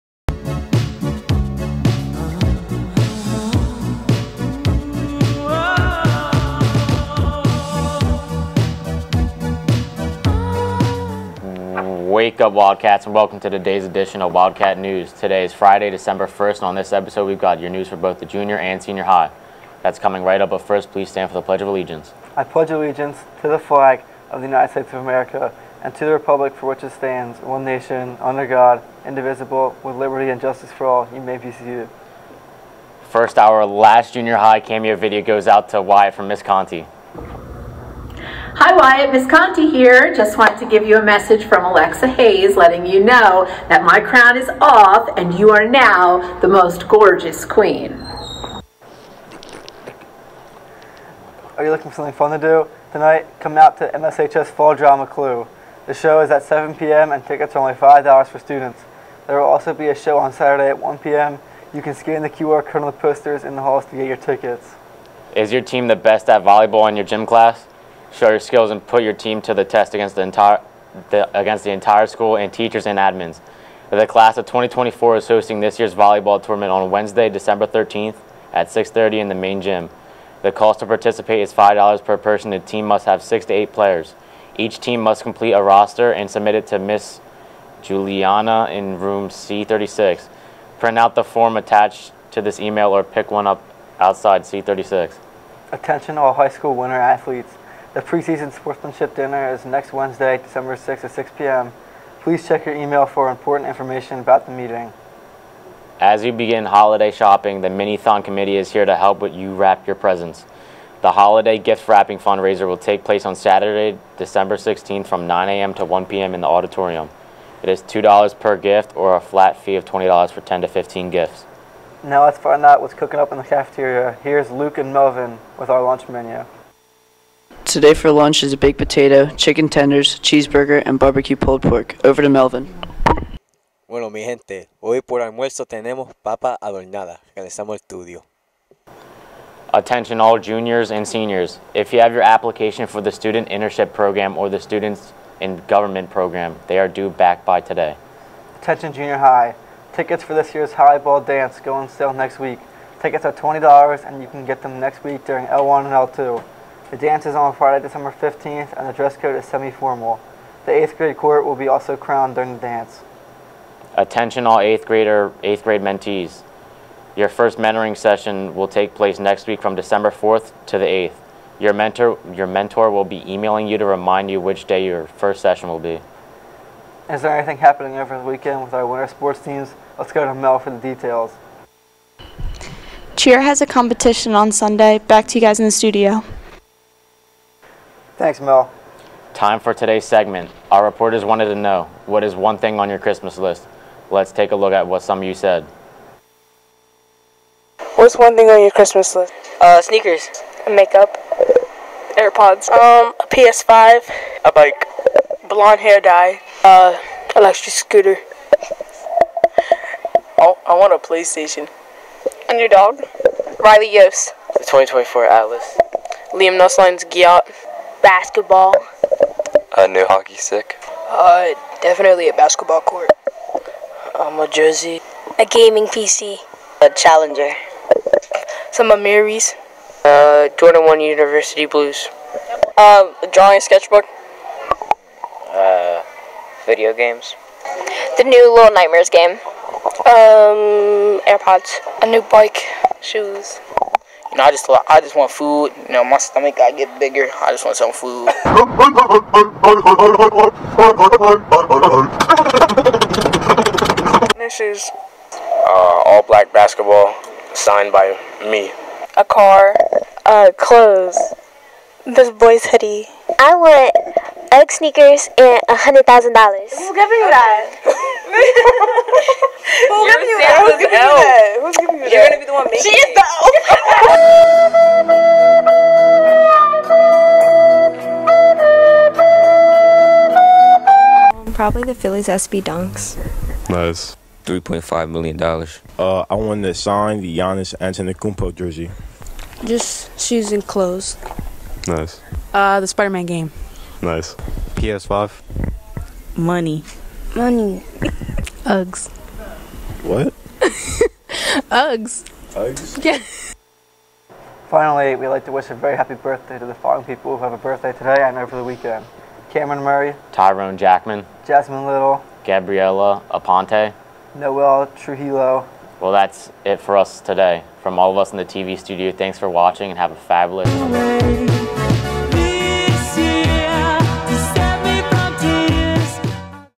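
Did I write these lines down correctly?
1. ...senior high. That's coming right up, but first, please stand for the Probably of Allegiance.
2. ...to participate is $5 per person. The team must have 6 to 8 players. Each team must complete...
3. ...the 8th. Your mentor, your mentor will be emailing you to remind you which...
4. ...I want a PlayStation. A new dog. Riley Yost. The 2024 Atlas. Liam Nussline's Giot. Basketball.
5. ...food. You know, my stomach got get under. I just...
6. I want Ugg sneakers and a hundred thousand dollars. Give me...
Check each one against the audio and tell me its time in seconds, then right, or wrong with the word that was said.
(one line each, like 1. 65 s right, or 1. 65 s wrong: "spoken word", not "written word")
1. 18 s wrong: "Pledge", not "Probably"
2. 80 s right
3. 170 s right
4. 210 s right
5. 245 s wrong: "bigger", not "under"
6. 263 s right.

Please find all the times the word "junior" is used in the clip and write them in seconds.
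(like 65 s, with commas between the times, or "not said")
18 s, 34 s, 140 s, 148 s.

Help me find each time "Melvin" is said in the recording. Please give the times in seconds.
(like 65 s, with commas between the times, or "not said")
124 s, 132 s.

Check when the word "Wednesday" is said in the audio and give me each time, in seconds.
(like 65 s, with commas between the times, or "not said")
76 s, 99 s.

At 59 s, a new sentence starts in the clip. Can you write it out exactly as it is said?
There will also be a show on Saturday at 1 p.m.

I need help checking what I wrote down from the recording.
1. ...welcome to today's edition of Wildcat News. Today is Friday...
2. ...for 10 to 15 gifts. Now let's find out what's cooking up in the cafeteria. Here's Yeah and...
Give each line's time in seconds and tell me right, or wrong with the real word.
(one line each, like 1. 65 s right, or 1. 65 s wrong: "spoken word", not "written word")
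1. 13 s right
2. 120 s wrong: "Luke", not "Yeah".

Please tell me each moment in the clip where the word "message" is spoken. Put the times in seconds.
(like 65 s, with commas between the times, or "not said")
41 s.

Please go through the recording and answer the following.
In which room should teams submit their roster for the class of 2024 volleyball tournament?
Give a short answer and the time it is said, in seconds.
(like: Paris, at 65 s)
C36, at 88 s.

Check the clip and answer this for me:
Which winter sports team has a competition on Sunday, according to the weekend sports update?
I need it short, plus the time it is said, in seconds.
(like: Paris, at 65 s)
Cheer, at 183 s.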